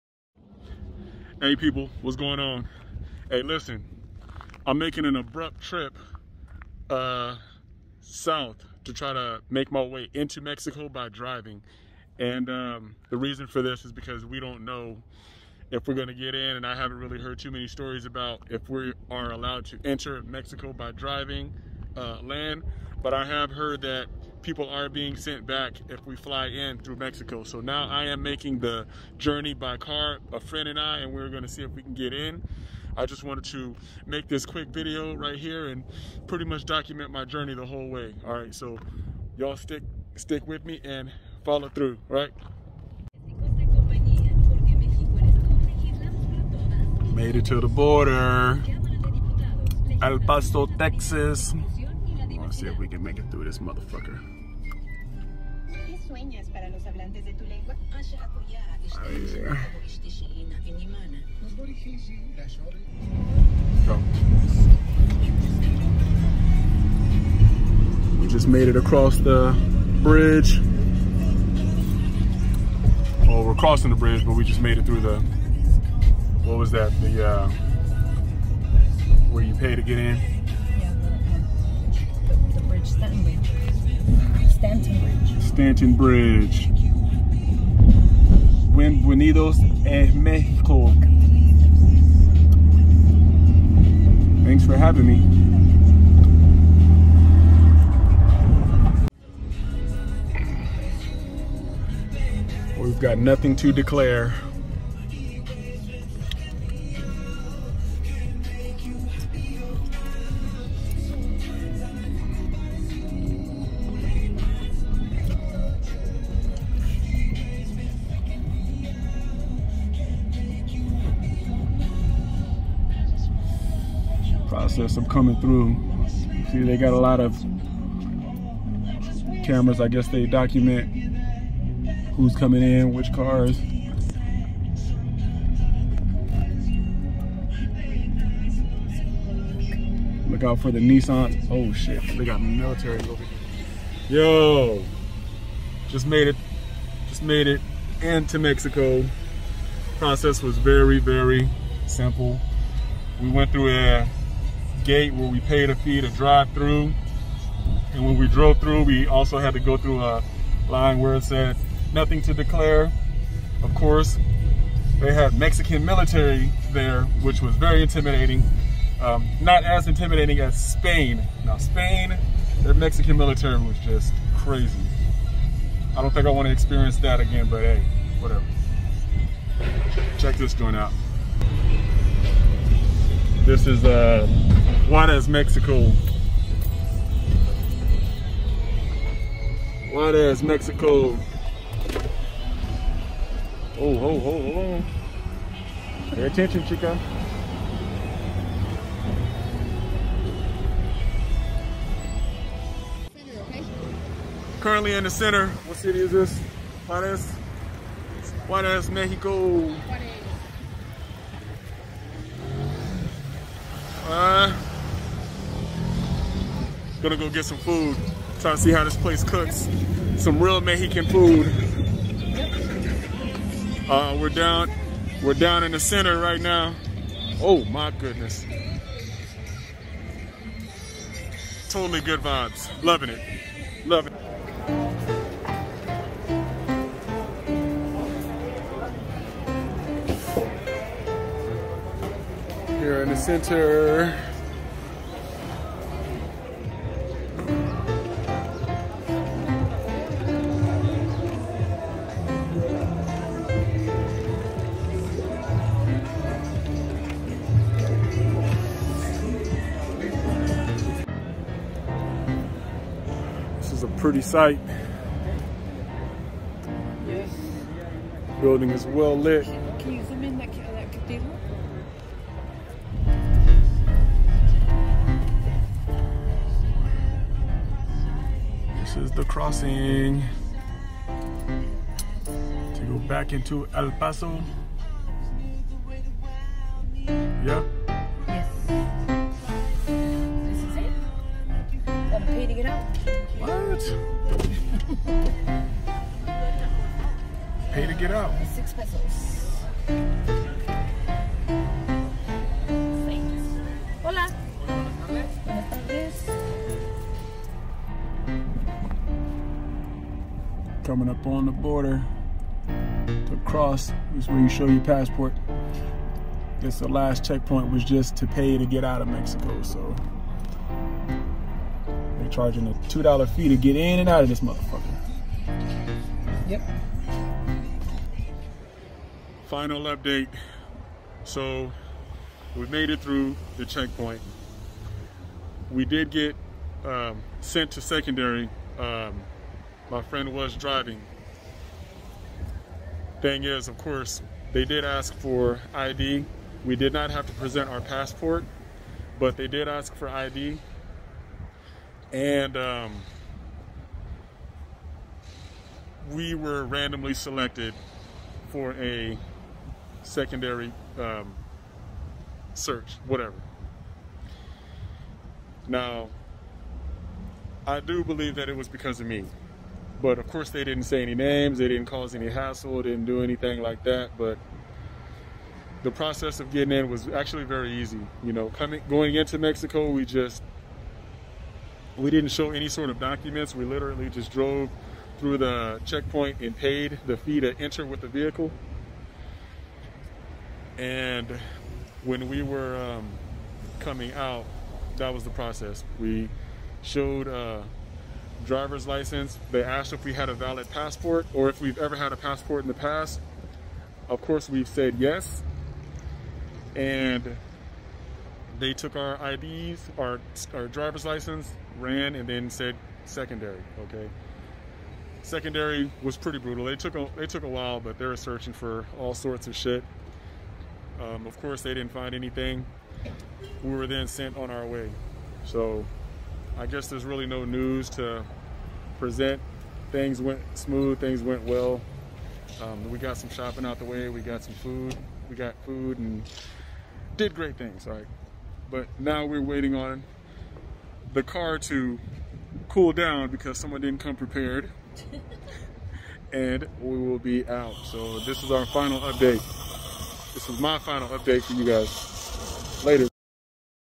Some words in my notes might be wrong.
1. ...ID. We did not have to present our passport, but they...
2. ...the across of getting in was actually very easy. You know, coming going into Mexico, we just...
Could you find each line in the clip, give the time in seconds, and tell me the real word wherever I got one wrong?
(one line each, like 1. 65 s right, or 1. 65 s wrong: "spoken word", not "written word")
1. 345 s right
2. 375 s wrong: "process", not "across".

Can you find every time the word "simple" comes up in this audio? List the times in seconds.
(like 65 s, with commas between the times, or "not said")
151 s.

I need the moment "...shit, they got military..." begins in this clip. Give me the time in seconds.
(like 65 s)
141 s.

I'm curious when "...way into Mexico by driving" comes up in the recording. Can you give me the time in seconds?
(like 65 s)
9 s.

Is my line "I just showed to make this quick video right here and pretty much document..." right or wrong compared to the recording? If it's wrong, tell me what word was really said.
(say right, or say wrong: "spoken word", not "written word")
wrong: "wanted", not "showed".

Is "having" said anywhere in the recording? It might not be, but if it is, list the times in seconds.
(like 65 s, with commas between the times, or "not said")
94 s.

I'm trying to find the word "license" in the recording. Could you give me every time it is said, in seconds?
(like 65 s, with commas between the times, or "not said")
398 s, 411 s.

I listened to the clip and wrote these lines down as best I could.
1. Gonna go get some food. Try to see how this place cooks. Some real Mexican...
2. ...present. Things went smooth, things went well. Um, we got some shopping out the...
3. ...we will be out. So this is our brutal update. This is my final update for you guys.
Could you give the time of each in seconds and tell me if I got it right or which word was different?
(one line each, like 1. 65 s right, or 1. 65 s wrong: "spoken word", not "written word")
1. 217 s right
2. 428 s right
3. 446 s wrong: "final", not "brutal".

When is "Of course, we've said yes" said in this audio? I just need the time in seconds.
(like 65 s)
404 s.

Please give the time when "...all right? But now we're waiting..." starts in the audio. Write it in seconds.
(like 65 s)
437 s.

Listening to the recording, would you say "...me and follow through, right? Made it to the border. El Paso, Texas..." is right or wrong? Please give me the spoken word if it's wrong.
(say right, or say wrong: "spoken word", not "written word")
right.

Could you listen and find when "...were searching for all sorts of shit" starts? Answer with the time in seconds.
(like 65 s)
418 s.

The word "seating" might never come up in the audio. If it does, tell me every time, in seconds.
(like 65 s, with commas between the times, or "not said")
not said.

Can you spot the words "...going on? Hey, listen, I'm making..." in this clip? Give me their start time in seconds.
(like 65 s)
2 s.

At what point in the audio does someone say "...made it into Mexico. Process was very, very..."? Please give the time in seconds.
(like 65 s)
147 s.